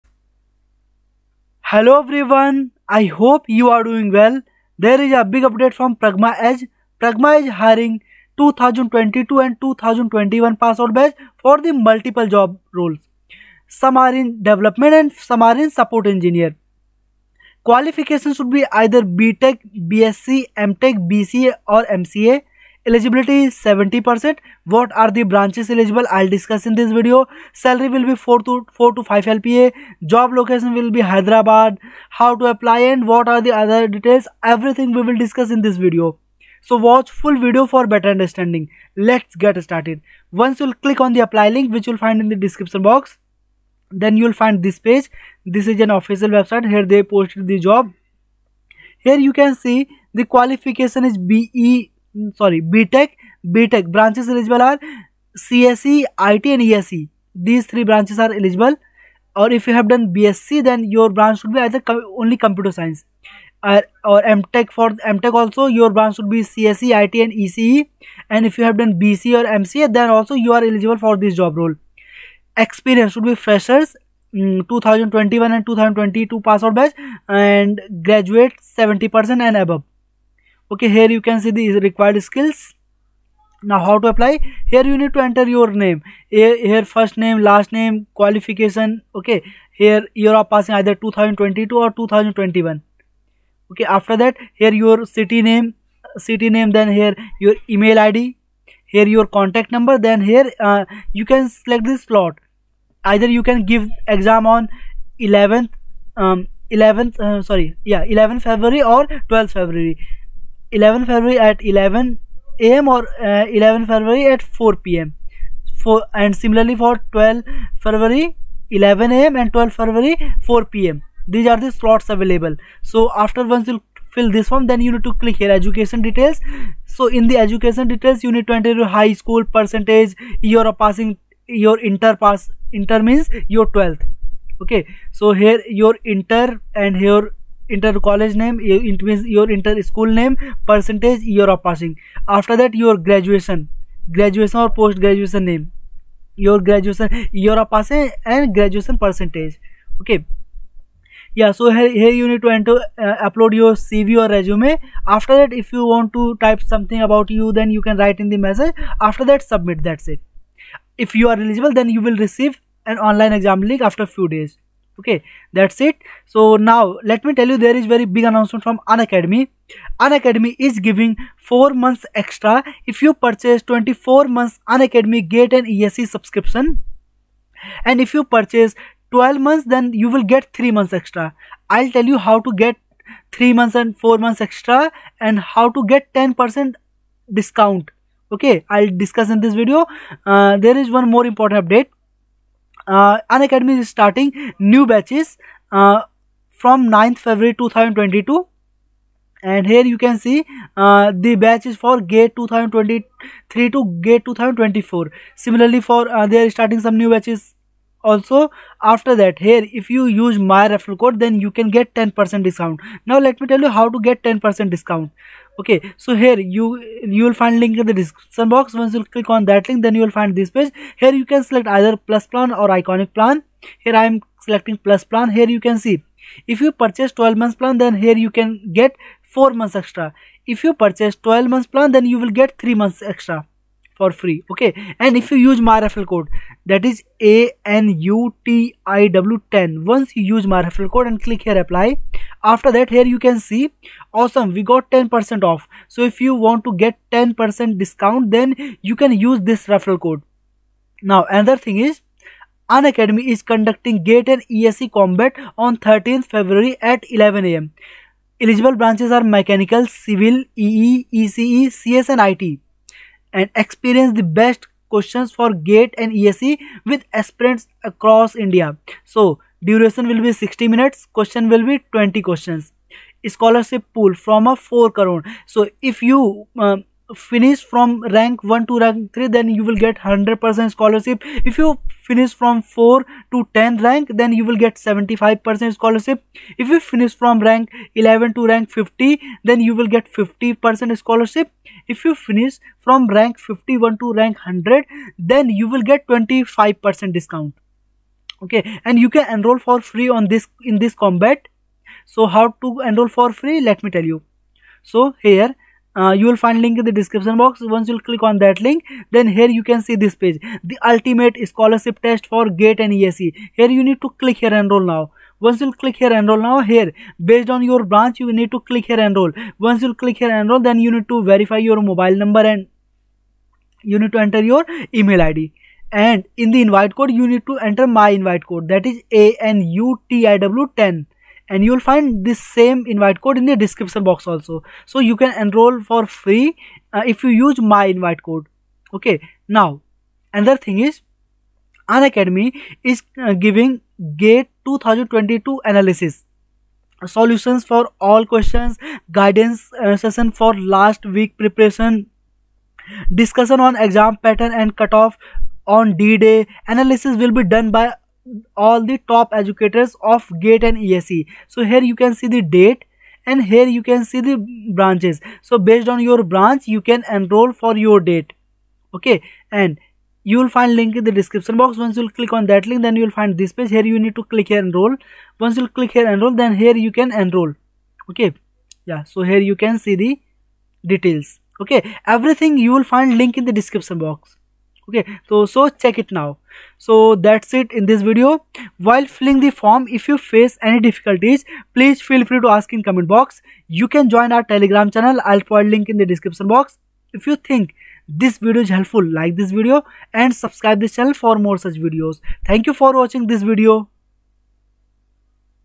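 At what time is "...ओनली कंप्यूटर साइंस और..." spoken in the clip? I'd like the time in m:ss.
1:01.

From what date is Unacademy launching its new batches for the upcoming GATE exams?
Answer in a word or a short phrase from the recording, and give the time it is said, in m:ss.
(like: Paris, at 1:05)
9 February 2022, at 3:16.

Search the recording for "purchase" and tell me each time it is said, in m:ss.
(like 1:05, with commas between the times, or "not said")
2:53, 2:58, 3:46, 3:50.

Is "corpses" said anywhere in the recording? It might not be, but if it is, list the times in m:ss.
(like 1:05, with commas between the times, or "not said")
not said.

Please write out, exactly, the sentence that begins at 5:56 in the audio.
Analysis will be done by all the top educators of GATE and ESE.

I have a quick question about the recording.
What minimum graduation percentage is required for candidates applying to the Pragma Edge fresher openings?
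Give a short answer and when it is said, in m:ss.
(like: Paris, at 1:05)
70%, at 1:18.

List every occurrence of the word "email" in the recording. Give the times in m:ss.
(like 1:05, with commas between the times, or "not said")
1:37, 5:25.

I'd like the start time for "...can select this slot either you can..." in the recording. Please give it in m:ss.
1:41.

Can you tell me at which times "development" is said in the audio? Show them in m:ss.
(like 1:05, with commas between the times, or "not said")
0:14.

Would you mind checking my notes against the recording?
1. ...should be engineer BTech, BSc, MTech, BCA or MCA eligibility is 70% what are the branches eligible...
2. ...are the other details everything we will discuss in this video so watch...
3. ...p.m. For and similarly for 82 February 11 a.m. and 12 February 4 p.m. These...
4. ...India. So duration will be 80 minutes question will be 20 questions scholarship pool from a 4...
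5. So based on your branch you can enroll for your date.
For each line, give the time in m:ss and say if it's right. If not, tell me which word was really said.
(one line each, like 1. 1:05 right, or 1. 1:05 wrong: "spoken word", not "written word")
1. 0:18 wrong: "either", not "engineer"
2. 0:33 right
3. 1:54 wrong: "12", not "82"
4. 4:28 wrong: "60", not "80"
5. 6:05 right.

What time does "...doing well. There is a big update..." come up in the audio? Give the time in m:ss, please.
0:03.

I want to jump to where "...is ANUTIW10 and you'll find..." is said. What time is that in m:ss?
5:28.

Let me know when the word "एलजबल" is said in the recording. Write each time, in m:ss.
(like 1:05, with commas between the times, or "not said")
0:54, 0:58, 1:10.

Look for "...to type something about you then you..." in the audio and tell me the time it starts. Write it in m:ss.
2:36.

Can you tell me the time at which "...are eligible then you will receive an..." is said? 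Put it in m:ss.
2:41.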